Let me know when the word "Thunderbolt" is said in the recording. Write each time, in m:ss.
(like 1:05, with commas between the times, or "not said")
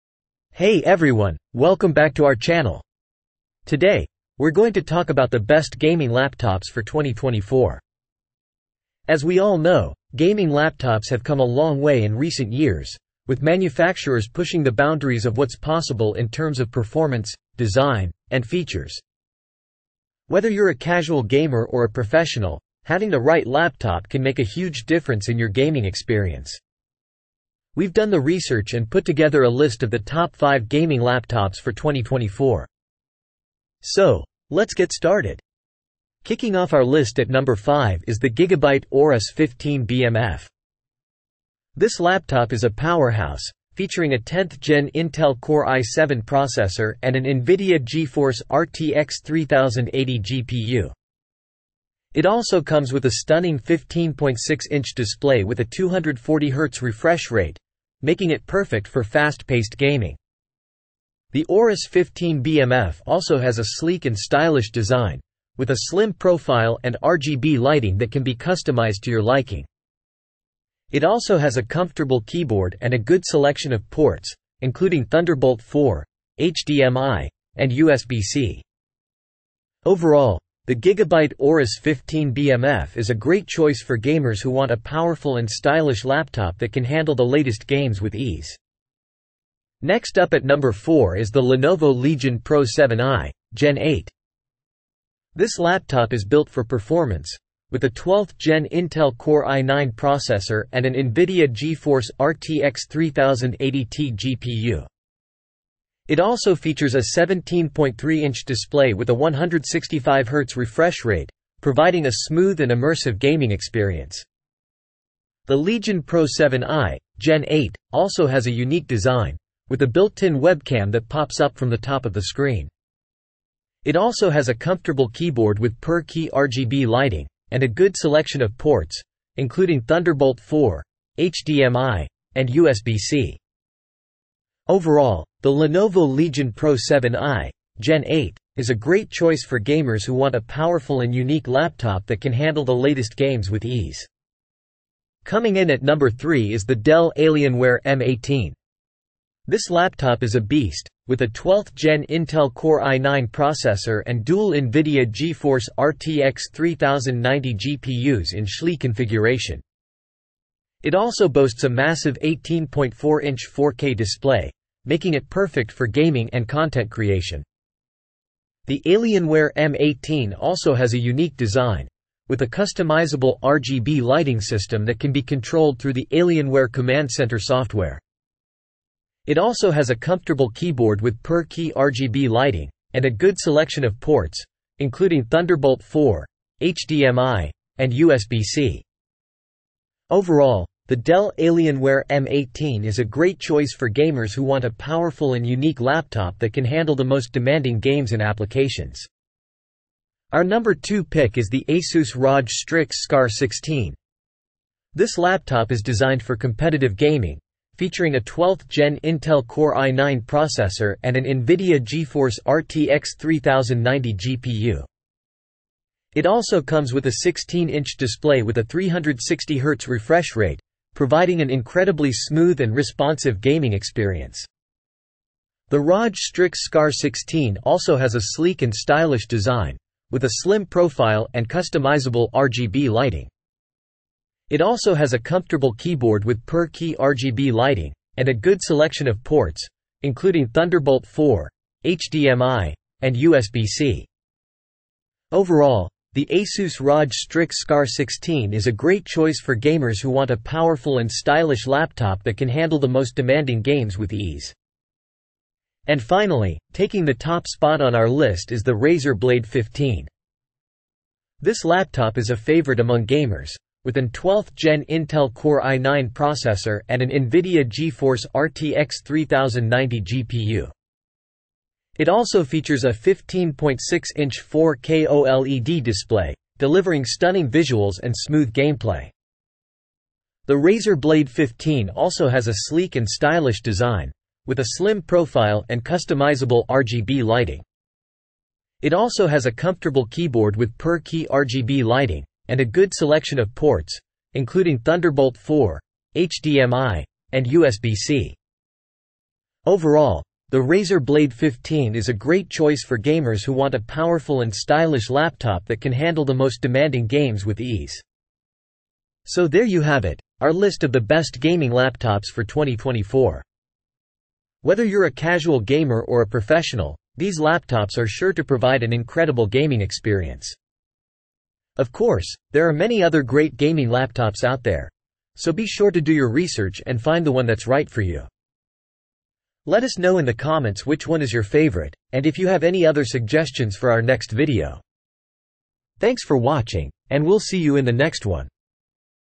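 1:15, 2:09, 3:05, 4:00, 4:54.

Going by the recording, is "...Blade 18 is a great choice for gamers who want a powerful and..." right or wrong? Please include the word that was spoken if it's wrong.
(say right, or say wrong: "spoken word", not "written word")
wrong: "15", not "18".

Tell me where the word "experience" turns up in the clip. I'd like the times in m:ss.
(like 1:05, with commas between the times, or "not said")
0:25, 1:53, 3:43, 5:19.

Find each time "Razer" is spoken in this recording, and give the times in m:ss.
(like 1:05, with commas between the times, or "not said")
4:18, 4:40, 5:00.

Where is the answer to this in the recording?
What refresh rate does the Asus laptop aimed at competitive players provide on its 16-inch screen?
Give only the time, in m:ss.
3:38.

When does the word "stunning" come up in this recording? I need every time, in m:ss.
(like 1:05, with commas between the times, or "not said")
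0:53, 4:37.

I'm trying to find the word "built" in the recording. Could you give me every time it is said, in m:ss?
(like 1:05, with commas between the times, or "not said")
1:36, 1:59.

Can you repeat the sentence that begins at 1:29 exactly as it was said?
Next up at number 4 is the Lenovo Legion Pro 7i, Gen 8.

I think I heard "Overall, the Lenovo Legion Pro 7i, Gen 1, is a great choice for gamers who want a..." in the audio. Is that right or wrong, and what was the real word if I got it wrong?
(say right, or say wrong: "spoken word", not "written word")
wrong: "8", not "1".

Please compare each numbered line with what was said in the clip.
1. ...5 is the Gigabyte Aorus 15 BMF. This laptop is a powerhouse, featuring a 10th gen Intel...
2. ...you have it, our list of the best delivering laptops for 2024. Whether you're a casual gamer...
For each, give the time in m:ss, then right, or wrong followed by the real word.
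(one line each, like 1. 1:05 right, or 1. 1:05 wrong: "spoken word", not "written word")
1. 0:37 right
2. 5:09 wrong: "gaming", not "delivering".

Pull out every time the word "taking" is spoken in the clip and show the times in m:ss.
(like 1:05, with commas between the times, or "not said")
4:16.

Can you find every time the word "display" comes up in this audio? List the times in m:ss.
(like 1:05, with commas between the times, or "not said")
0:54, 1:48, 2:43, 3:37, 4:35.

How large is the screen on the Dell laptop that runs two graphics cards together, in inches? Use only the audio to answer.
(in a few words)
18.4-inch.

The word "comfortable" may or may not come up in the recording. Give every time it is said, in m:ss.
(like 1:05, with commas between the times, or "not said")
1:11, 2:04, 2:59, 3:55, 4:49.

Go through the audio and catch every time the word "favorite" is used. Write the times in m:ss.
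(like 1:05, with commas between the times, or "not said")
4:22, 5:31.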